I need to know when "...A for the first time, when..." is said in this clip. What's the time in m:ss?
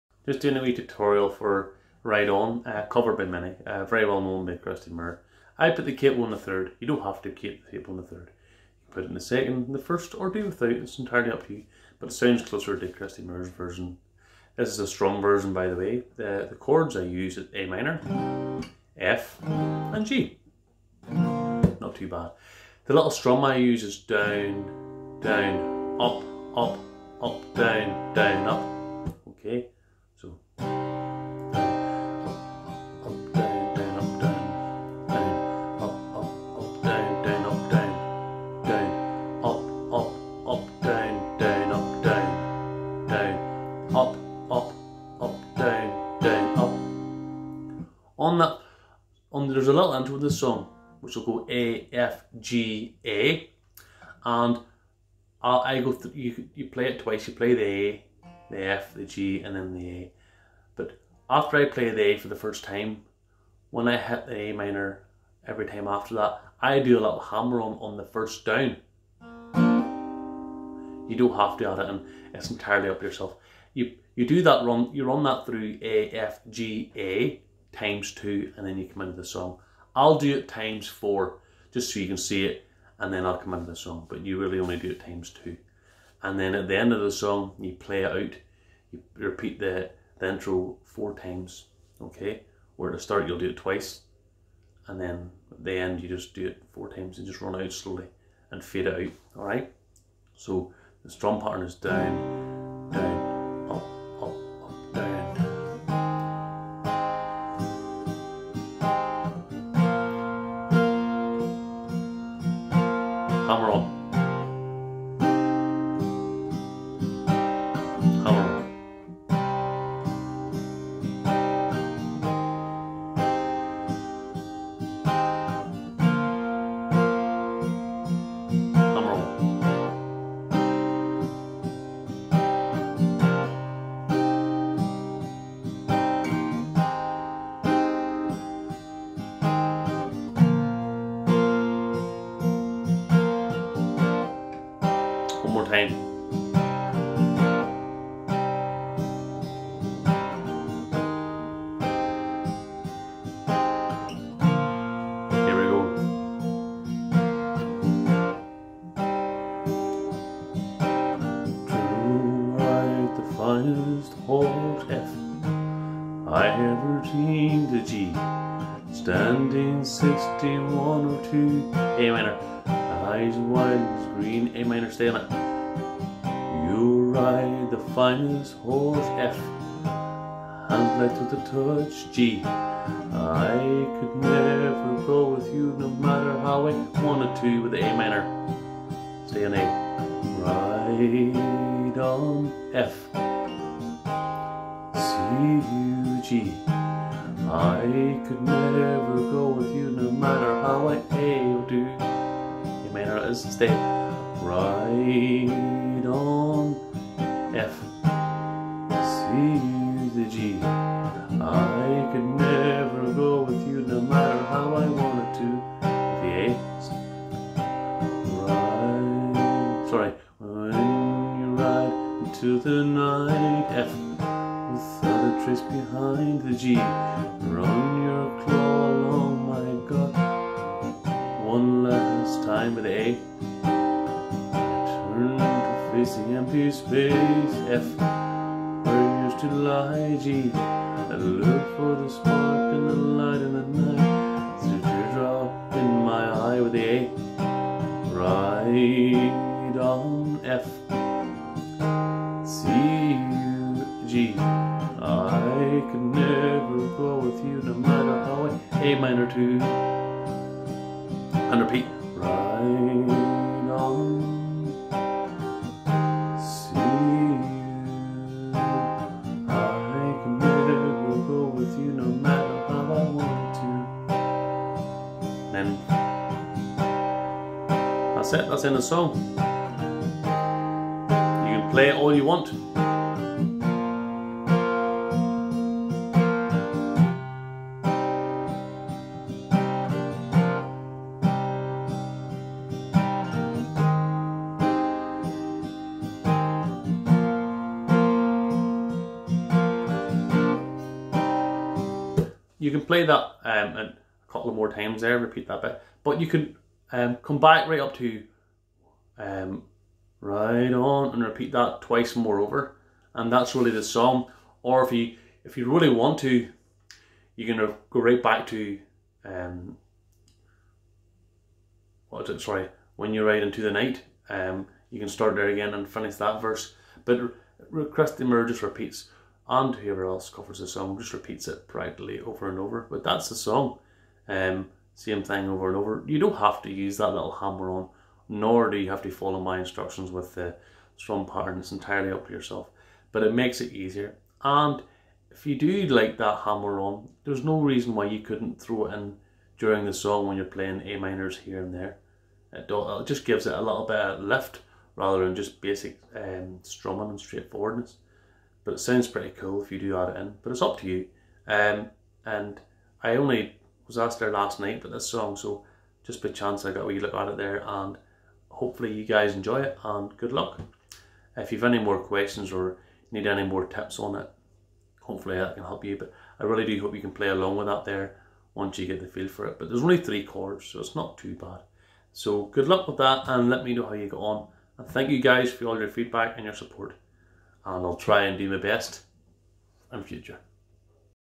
1:02.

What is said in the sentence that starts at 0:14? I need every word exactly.
This is a strong version, by the way.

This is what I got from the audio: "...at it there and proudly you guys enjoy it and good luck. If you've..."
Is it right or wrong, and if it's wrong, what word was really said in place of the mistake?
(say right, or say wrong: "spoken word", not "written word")
wrong: "hopefully", not "proudly".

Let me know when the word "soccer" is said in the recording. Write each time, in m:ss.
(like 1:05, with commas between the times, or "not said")
not said.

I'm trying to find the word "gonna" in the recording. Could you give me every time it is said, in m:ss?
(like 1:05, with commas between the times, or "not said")
5:17.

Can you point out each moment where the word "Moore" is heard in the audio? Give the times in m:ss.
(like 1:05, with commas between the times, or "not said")
0:04, 0:13.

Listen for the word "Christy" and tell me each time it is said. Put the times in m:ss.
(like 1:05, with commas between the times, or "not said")
0:04, 0:12.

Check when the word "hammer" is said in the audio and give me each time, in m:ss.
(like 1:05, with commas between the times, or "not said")
1:07, 5:37, 5:46.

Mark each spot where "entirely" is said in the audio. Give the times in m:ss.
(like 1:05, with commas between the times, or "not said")
0:10, 1:12, 5:41.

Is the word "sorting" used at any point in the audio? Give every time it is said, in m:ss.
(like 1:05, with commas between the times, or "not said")
not said.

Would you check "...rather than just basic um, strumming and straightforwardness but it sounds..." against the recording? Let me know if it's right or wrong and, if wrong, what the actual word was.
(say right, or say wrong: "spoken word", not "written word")
right.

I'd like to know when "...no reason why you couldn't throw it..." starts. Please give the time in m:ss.
5:47.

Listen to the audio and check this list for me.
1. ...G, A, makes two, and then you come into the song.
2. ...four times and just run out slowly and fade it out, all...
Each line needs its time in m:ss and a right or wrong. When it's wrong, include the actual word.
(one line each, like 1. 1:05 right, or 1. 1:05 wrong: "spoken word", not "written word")
1. 1:16 wrong: "times", not "makes"
2. 1:36 right.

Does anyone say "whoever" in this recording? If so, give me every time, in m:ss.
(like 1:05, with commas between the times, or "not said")
5:29.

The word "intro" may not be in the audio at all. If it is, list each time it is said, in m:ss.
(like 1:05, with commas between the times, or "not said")
0:49, 1:30.